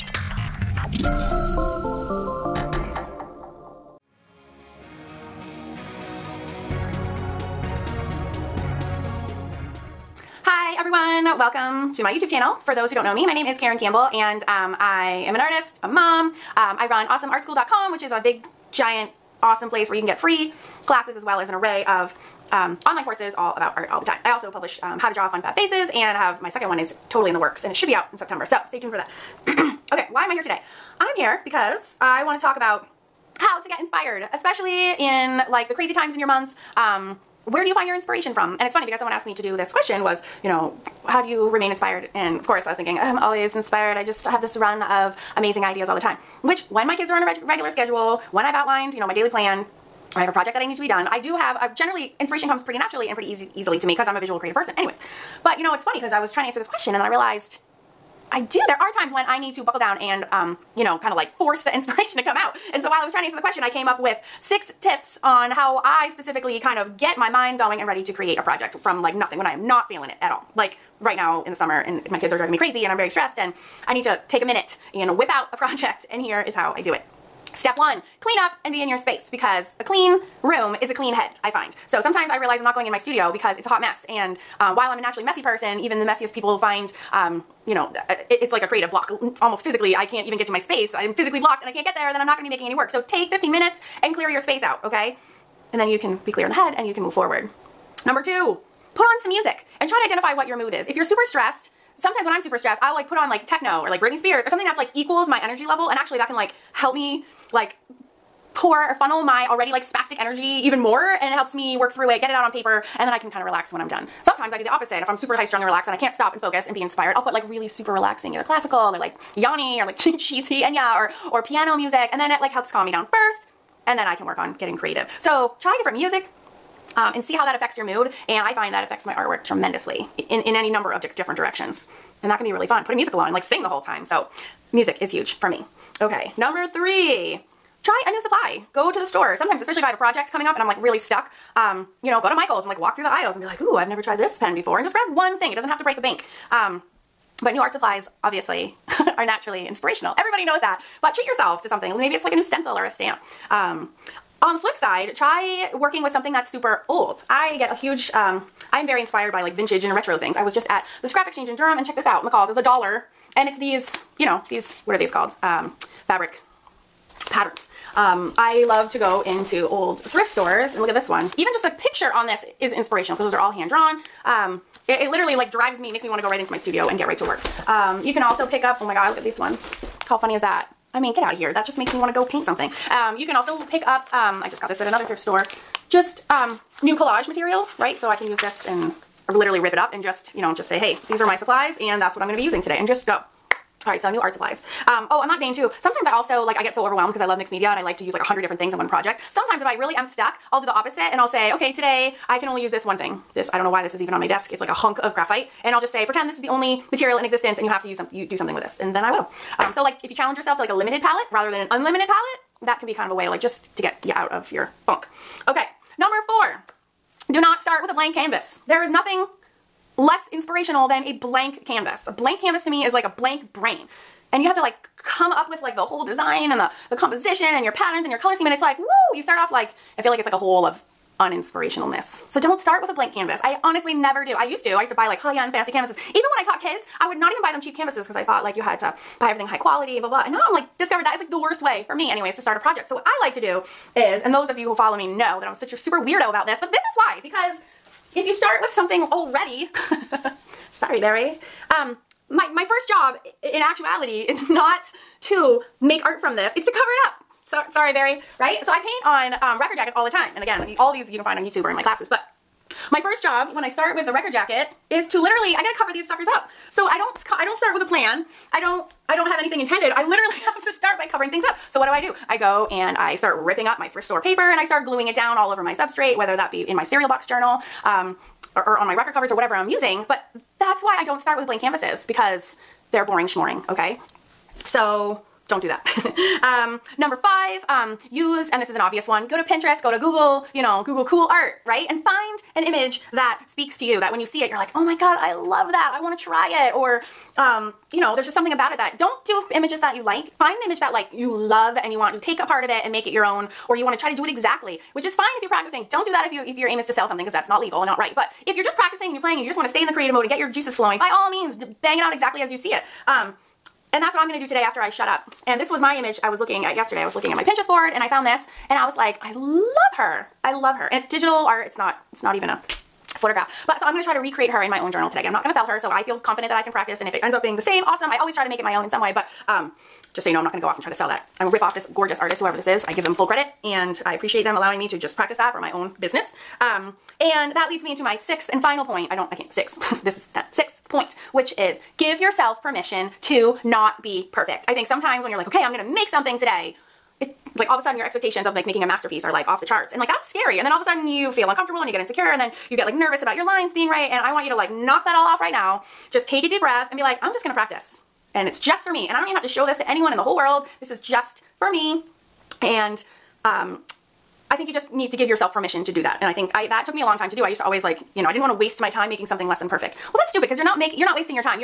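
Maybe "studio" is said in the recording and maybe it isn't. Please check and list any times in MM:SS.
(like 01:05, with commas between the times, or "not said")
01:22, 02:56.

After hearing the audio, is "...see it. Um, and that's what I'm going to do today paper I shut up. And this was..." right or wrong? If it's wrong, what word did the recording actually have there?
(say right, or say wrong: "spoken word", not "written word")
wrong: "after", not "paper".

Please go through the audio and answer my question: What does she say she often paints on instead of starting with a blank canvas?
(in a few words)
record jackets.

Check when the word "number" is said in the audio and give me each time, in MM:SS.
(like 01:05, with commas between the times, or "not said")
01:38, 02:10, 02:16, 03:35, 04:46.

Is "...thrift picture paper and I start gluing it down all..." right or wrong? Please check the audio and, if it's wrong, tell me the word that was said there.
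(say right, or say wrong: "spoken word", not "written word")
wrong: "store", not "picture".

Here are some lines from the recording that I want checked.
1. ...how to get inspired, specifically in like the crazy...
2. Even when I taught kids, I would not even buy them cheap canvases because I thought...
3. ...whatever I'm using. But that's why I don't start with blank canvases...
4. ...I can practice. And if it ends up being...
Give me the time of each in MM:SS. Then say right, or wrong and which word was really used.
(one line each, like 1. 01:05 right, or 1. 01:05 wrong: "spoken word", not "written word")
1. 00:33 wrong: "especially", not "specifically"
2. 03:56 right
3. 04:39 right
4. 05:26 right.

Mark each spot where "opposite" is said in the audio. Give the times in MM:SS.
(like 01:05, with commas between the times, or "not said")
01:54, 03:20.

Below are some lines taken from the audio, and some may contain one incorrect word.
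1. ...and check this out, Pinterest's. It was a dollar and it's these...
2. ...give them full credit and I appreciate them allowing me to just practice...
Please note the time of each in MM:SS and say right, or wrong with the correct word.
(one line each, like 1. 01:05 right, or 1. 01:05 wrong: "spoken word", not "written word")
1. 02:41 wrong: "McCall", not "Pinterest"
2. 05:32 right.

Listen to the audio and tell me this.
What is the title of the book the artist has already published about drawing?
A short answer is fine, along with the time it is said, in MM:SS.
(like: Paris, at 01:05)
How to Draw Fun Fab Faces, at 00:24.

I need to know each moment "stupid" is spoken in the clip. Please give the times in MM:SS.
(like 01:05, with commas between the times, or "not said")
06:10.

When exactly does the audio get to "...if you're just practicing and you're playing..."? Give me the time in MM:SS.
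05:08.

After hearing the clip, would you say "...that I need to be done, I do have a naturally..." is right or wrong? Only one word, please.
wrong.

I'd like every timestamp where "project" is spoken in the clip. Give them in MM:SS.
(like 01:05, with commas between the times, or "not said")
00:50, 01:08, 01:15, 02:19, 03:18, 04:02.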